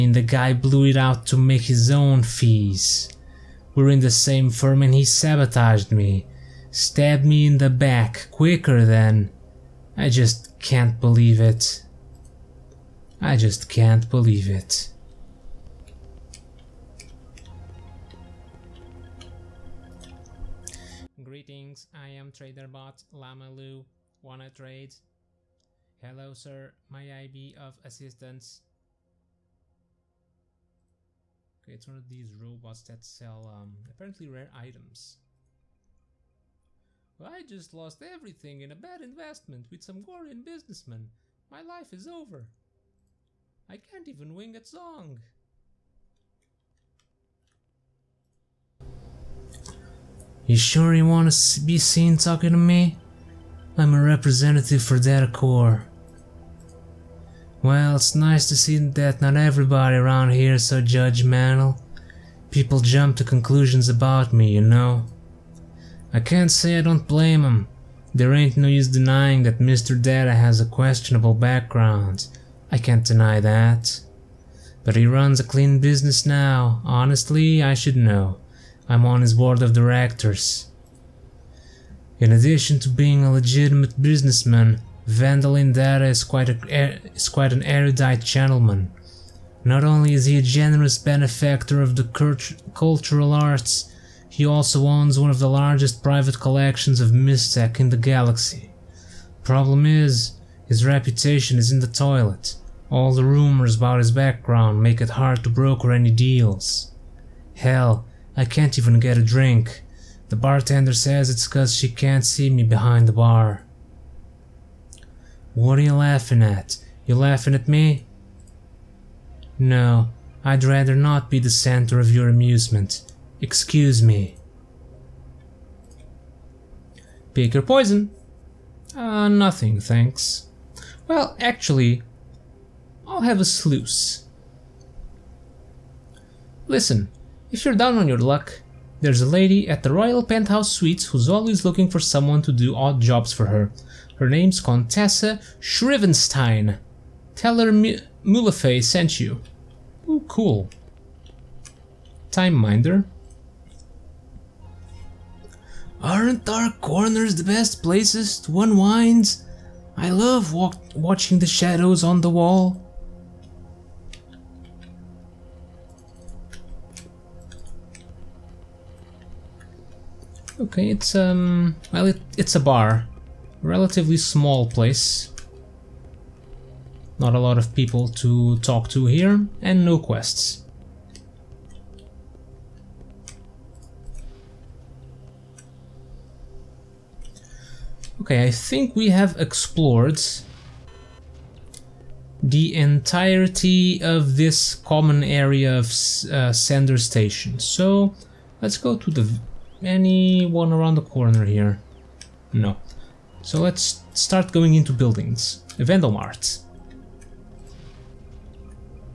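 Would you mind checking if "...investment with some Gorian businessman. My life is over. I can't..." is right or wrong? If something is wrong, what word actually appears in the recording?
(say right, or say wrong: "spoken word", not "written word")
right.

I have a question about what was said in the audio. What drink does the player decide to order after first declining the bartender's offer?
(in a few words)
A sluice.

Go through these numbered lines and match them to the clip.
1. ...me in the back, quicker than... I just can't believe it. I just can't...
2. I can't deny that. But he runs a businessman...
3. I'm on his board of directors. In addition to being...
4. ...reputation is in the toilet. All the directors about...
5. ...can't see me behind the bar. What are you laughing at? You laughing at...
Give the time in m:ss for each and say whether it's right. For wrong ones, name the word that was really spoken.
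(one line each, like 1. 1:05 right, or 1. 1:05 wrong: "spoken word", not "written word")
1. 0:07 right
2. 1:12 wrong: "clean", not "businessman"
3. 1:18 right
4. 1:40 wrong: "rumors", not "directors"
5. 1:51 right.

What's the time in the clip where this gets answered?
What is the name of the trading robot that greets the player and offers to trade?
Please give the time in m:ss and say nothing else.
0:22.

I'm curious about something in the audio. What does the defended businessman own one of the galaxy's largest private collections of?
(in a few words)
Mystech.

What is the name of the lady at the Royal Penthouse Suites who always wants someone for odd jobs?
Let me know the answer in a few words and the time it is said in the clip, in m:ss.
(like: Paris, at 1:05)
Contessa Shrivenstein, at 2:24.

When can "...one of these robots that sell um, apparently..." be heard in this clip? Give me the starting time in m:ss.
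0:31.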